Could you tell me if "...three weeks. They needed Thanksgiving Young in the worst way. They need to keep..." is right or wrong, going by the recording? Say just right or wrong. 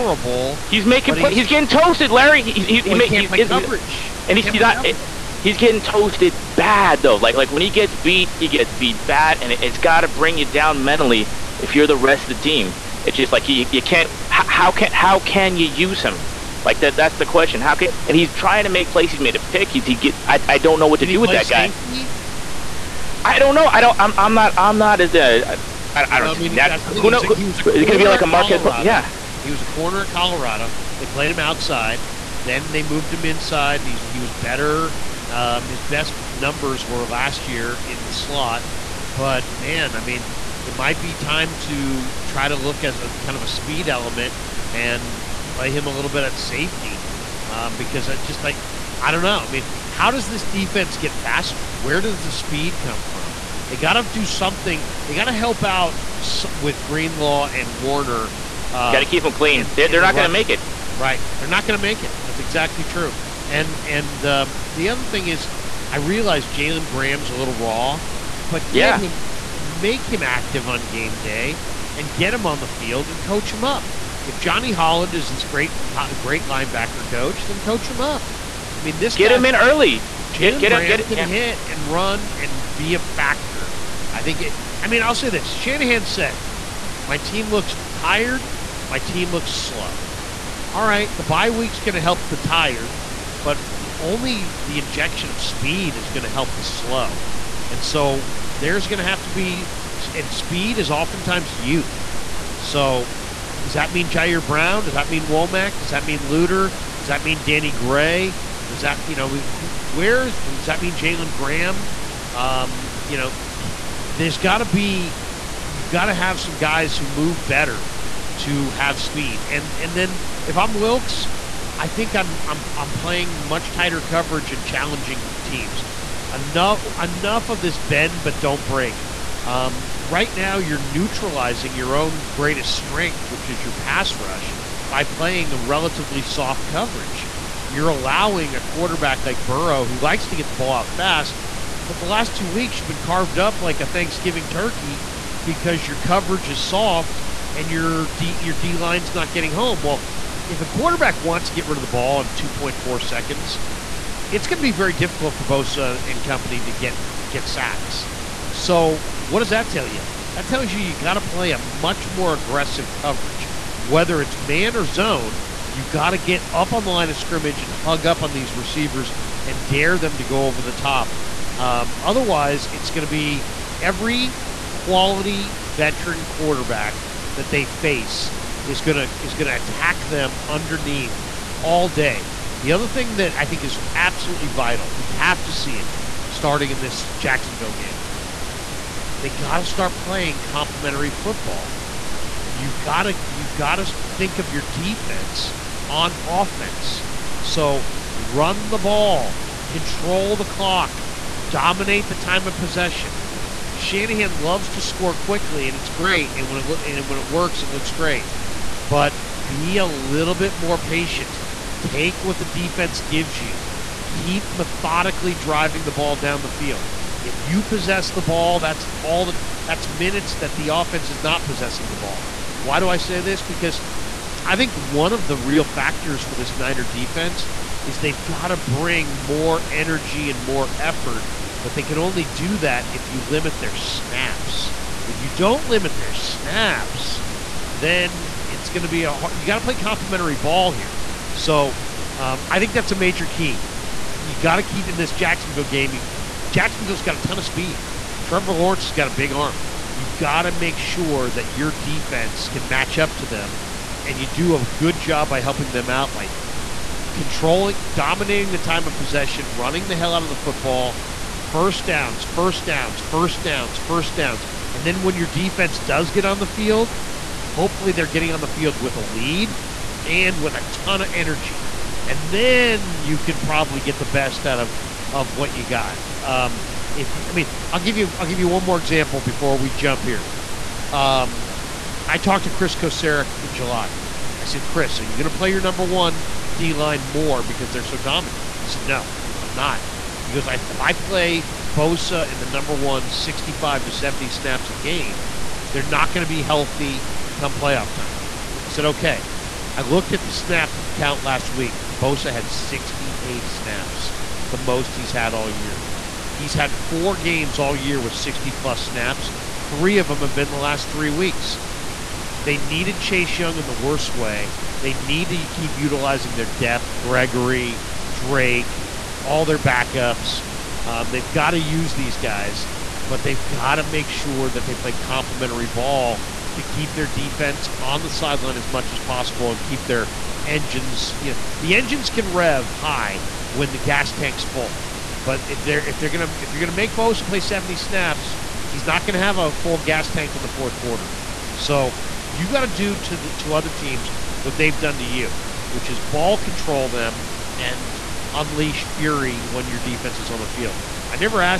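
wrong.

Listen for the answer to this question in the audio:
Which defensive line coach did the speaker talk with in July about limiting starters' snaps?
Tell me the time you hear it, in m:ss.
4:42.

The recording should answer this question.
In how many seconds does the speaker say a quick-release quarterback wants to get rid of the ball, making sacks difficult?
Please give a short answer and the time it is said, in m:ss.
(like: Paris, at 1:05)
2.4, at 2:32.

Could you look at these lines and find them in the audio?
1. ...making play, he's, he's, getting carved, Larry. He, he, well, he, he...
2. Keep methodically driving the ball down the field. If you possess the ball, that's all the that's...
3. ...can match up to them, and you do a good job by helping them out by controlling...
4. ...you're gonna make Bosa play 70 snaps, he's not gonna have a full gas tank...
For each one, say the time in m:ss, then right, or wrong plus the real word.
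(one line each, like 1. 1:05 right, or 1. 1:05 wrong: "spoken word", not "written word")
1. 0:00 wrong: "toasted", not "carved"
2. 3:34 right
3. 4:12 right
4. 5:36 right.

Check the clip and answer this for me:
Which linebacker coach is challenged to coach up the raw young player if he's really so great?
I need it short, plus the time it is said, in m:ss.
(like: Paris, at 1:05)
Johnny Holland, at 1:14.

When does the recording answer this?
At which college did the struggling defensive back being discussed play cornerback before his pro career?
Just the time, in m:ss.
0:30.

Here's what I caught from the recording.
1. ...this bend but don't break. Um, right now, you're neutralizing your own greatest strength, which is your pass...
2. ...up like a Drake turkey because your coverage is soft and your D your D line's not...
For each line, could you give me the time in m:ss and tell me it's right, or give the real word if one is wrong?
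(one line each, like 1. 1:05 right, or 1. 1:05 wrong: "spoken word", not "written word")
1. 2:07 right
2. 2:23 wrong: "Thanksgiving", not "Drake".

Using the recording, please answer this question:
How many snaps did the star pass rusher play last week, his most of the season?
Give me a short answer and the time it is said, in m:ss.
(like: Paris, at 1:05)
68, at 5:02.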